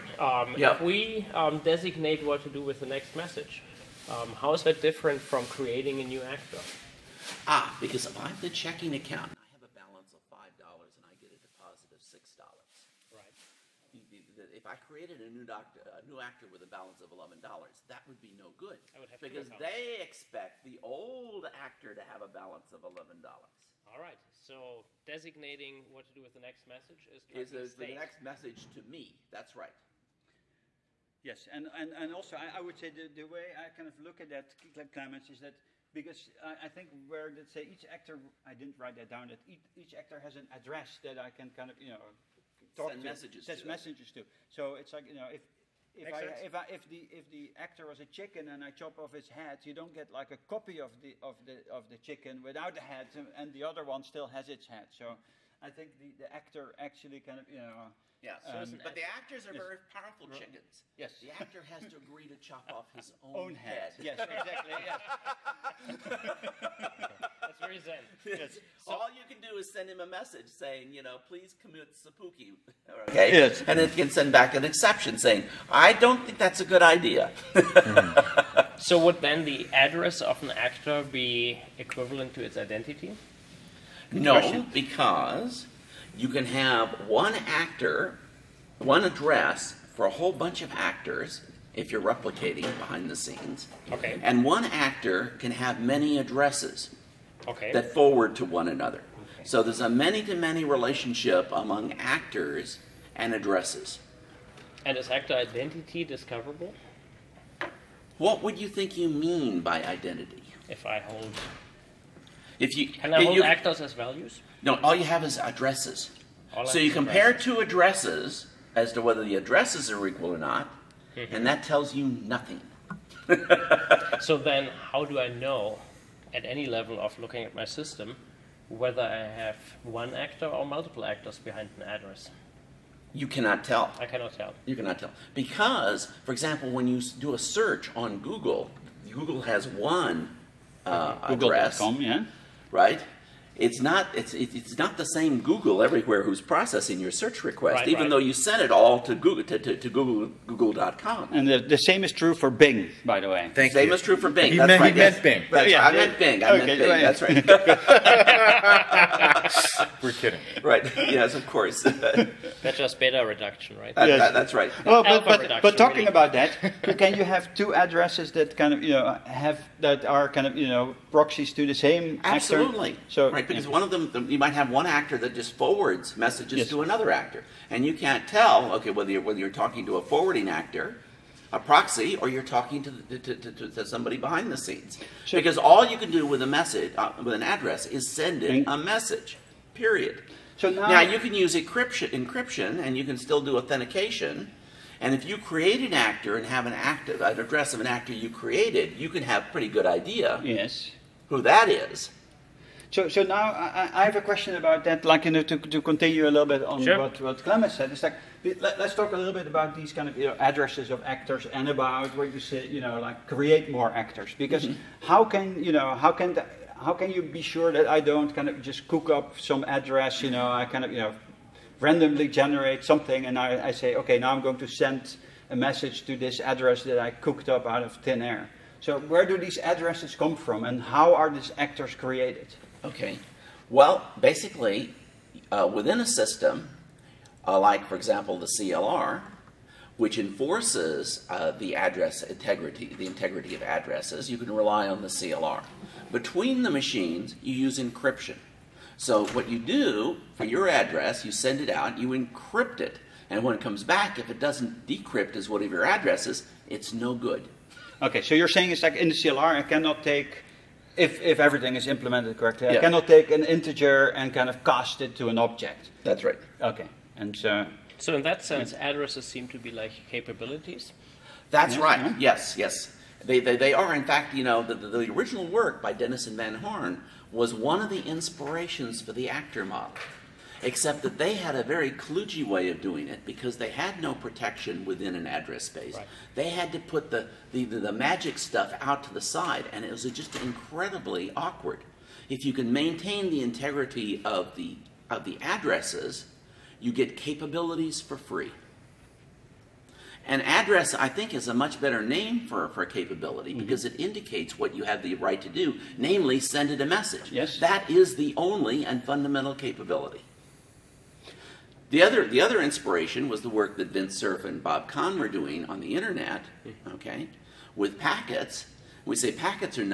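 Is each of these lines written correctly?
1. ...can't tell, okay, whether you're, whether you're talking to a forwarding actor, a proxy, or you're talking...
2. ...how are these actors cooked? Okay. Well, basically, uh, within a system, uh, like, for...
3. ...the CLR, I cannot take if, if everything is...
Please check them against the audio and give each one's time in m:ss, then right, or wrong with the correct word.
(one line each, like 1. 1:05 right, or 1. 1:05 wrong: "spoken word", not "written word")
1. 2:57 right
2. 3:50 wrong: "created", not "cooked"
3. 4:19 right.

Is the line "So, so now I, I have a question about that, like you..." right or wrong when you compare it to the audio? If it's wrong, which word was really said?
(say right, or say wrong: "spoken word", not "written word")
right.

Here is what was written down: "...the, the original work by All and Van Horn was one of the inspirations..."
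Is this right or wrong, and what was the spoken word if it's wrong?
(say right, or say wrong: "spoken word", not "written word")
wrong: "Dennis", not "All".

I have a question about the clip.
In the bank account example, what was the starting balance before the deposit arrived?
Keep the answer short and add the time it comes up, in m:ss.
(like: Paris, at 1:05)
$5, at 0:09.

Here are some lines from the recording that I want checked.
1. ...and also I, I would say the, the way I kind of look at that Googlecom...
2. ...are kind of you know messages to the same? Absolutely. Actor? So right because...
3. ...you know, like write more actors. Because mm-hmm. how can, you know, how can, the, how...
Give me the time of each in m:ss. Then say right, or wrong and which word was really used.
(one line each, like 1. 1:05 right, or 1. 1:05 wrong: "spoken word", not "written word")
1. 0:31 wrong: "Clemens", not "Googlecom"
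2. 2:50 wrong: "proxies", not "messages"
3. 3:32 wrong: "create", not "write".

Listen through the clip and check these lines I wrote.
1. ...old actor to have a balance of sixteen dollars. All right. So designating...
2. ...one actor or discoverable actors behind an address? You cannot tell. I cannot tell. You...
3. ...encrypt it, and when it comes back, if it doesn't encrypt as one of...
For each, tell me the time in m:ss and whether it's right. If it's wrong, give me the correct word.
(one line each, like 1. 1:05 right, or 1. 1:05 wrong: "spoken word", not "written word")
1. 0:20 wrong: "eleven", not "sixteen"
2. 2:10 wrong: "multiple", not "discoverable"
3. 4:12 wrong: "decrypt", not "encrypt".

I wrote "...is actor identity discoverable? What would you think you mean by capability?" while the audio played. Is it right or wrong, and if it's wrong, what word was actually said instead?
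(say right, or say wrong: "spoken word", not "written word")
wrong: "identity", not "capability".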